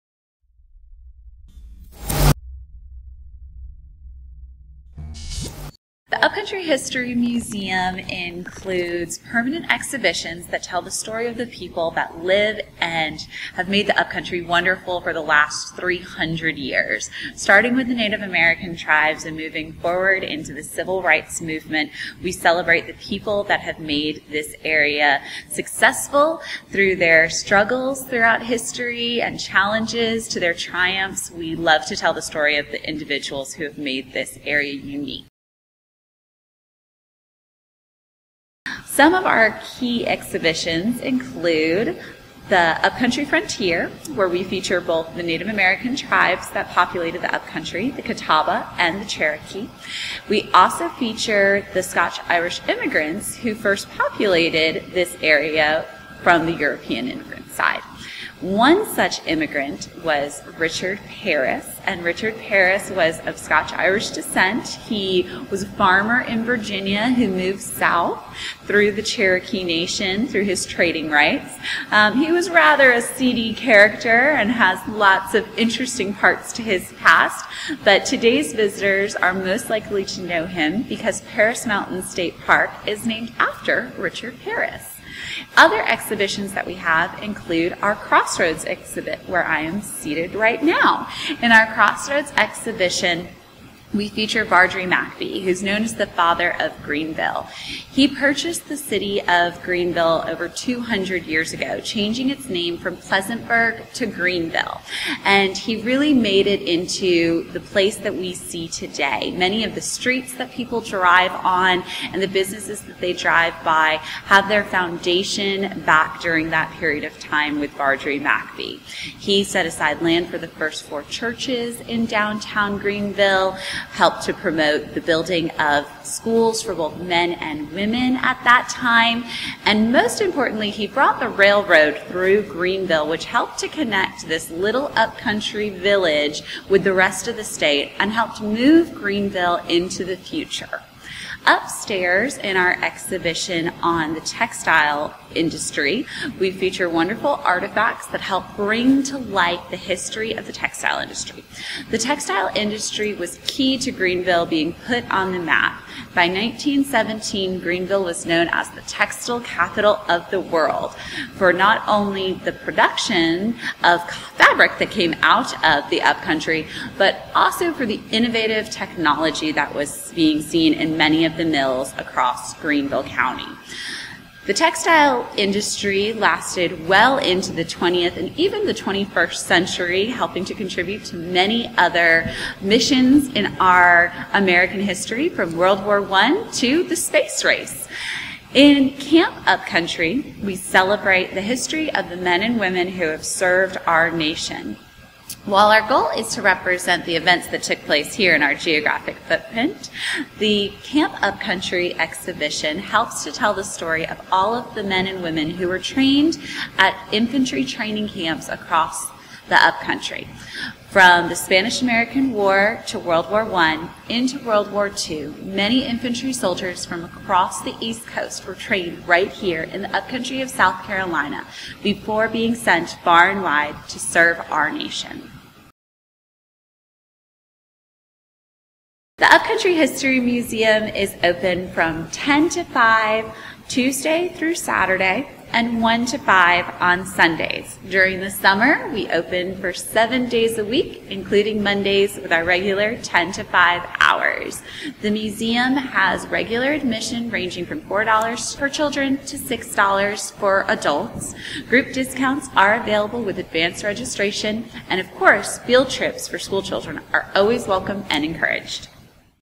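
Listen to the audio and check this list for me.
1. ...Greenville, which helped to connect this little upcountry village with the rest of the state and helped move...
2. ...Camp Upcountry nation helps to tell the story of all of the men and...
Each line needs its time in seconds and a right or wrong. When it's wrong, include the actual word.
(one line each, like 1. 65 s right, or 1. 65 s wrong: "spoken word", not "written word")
1. 132 s right
2. 200 s wrong: "exhibition", not "nation".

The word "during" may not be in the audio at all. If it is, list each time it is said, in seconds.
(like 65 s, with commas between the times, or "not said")
116 s, 237 s.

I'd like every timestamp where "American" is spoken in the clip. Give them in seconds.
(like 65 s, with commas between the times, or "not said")
18 s, 45 s, 184 s, 211 s.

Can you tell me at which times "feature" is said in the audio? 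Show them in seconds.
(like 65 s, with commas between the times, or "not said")
44 s, 50 s, 94 s, 146 s.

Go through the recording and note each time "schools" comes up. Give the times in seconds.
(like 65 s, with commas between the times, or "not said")
126 s, 256 s.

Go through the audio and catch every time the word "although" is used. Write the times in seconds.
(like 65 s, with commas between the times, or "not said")
not said.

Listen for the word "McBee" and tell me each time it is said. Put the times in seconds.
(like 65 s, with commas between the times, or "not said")
94 s, 118 s.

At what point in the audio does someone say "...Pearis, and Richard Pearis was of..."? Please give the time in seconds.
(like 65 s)
61 s.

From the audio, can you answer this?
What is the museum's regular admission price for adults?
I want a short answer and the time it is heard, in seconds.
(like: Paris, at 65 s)
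$6, at 249 s.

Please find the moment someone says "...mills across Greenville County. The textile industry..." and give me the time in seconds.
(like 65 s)
171 s.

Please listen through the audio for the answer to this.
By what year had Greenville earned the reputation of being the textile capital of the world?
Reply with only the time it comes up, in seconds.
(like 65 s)
156 s.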